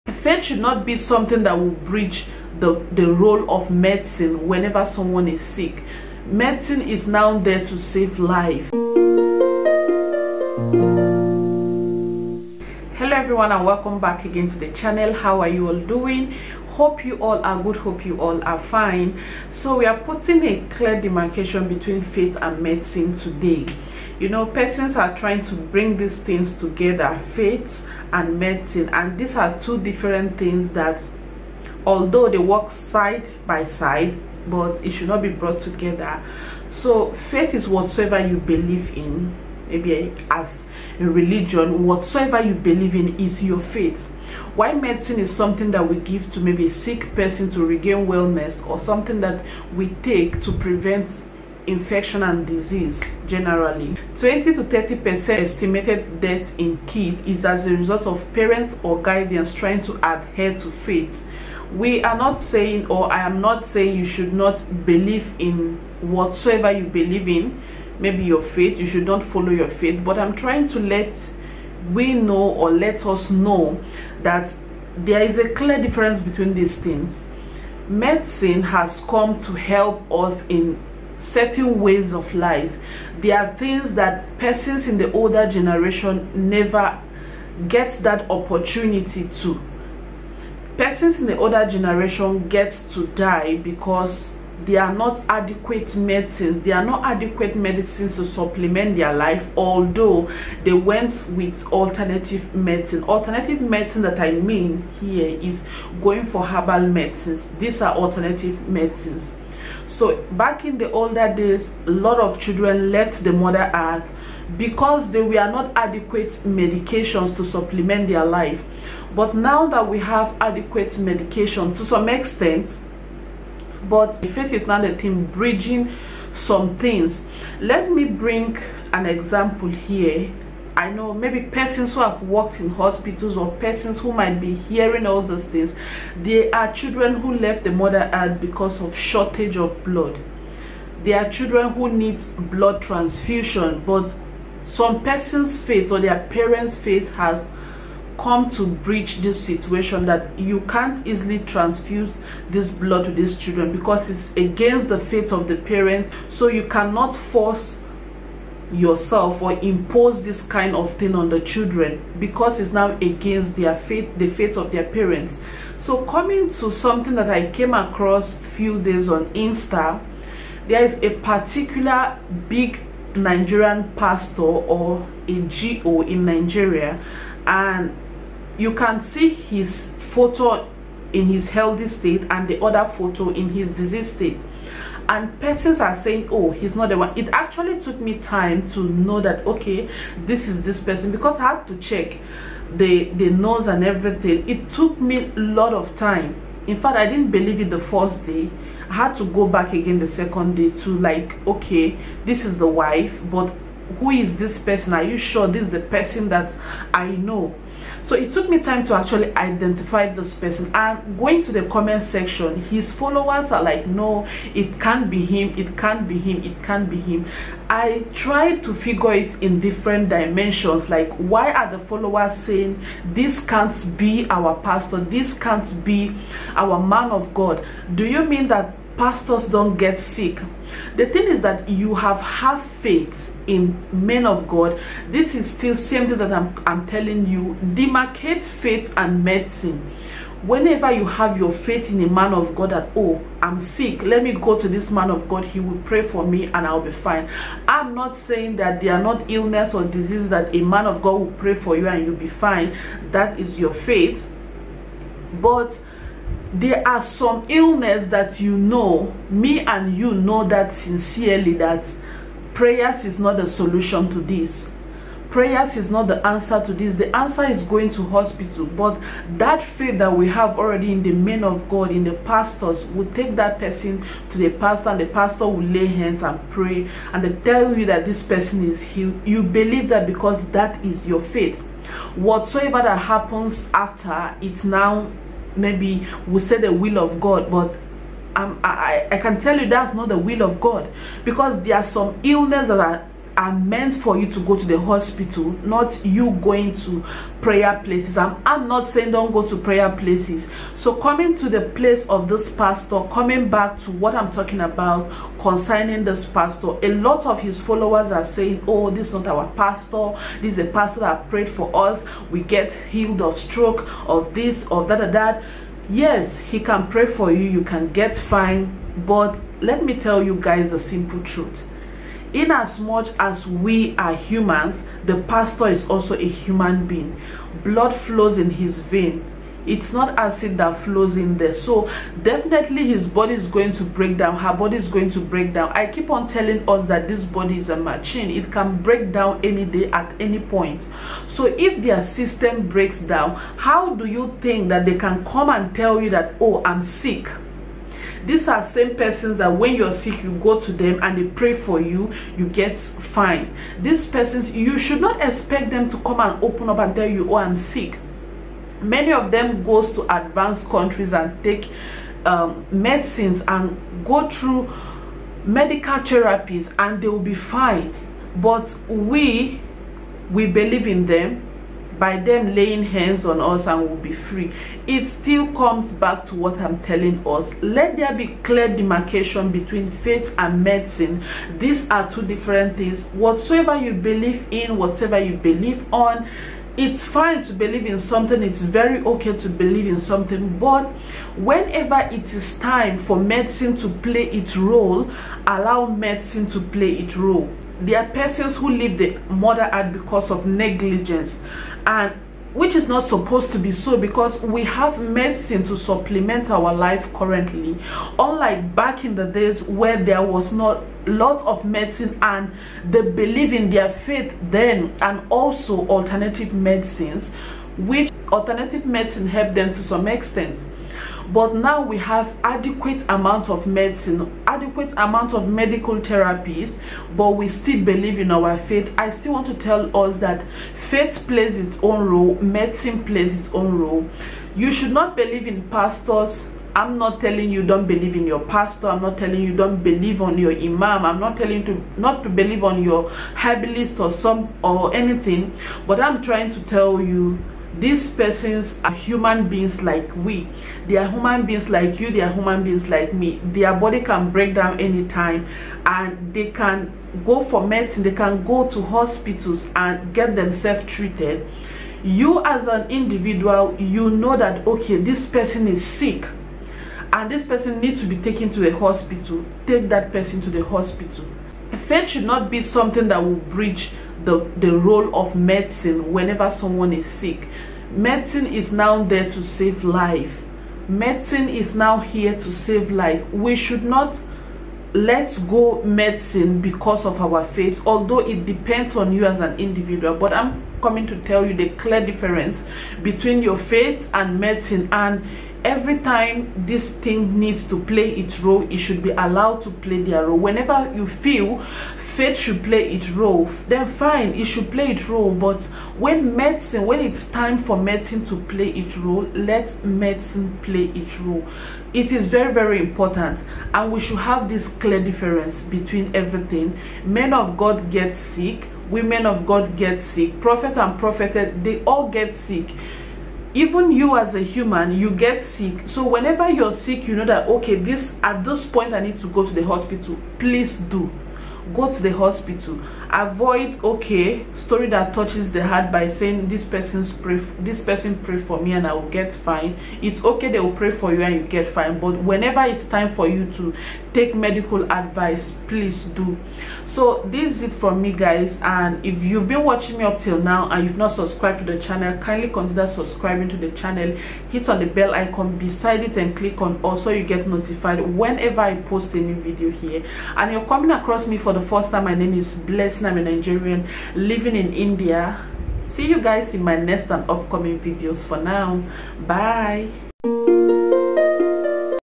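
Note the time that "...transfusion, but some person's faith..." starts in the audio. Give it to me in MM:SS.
02:22.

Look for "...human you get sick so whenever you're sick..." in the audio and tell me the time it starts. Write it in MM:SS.
08:44.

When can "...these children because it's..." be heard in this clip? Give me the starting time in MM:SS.
02:33.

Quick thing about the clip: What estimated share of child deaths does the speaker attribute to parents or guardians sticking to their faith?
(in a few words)
20 to 30 percent.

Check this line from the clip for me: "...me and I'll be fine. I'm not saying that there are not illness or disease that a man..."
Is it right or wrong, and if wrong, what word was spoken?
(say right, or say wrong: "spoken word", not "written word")
right.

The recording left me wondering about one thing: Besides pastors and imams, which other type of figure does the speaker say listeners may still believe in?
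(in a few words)
herbalist.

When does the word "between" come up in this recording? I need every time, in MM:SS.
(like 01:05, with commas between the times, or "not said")
00:21, 01:16, 06:19, 08:13, 08:35.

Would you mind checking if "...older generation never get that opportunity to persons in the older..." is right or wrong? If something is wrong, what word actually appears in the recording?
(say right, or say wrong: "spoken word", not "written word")
right.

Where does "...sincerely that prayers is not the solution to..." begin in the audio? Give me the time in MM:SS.
04:20.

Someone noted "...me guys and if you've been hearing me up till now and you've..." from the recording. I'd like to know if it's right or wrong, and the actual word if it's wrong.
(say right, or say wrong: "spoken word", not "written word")
wrong: "watching", not "hearing".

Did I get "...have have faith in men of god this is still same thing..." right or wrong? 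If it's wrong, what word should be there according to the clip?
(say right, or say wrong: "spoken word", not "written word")
right.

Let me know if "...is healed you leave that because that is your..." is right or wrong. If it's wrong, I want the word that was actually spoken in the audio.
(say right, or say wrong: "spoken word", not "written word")
wrong: "believe", not "leave".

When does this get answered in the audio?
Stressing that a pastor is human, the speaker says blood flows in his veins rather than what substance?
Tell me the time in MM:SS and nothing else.
05:30.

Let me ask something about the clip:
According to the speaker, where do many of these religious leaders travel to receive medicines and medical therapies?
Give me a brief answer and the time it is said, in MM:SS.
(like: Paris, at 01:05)
advanced countries, at 06:00.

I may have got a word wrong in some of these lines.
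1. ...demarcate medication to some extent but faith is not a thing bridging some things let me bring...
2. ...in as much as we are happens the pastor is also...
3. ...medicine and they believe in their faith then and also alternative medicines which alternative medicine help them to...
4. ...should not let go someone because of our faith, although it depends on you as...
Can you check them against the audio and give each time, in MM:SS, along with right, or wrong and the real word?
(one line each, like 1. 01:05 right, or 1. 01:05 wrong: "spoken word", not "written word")
1. 02:00 wrong: "adequate", not "demarcate"
2. 05:22 wrong: "humans", not "happens"
3. 06:51 right
4. 08:03 wrong: "medicine", not "someone".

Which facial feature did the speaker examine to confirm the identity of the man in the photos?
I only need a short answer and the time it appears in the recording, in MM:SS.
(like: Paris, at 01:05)
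the nose, at 03:13.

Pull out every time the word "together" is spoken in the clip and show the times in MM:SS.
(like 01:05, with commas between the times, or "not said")
00:26, 00:35.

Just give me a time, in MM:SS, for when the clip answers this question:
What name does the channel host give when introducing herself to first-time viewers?
09:22.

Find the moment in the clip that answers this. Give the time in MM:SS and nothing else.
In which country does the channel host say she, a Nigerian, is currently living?
09:24.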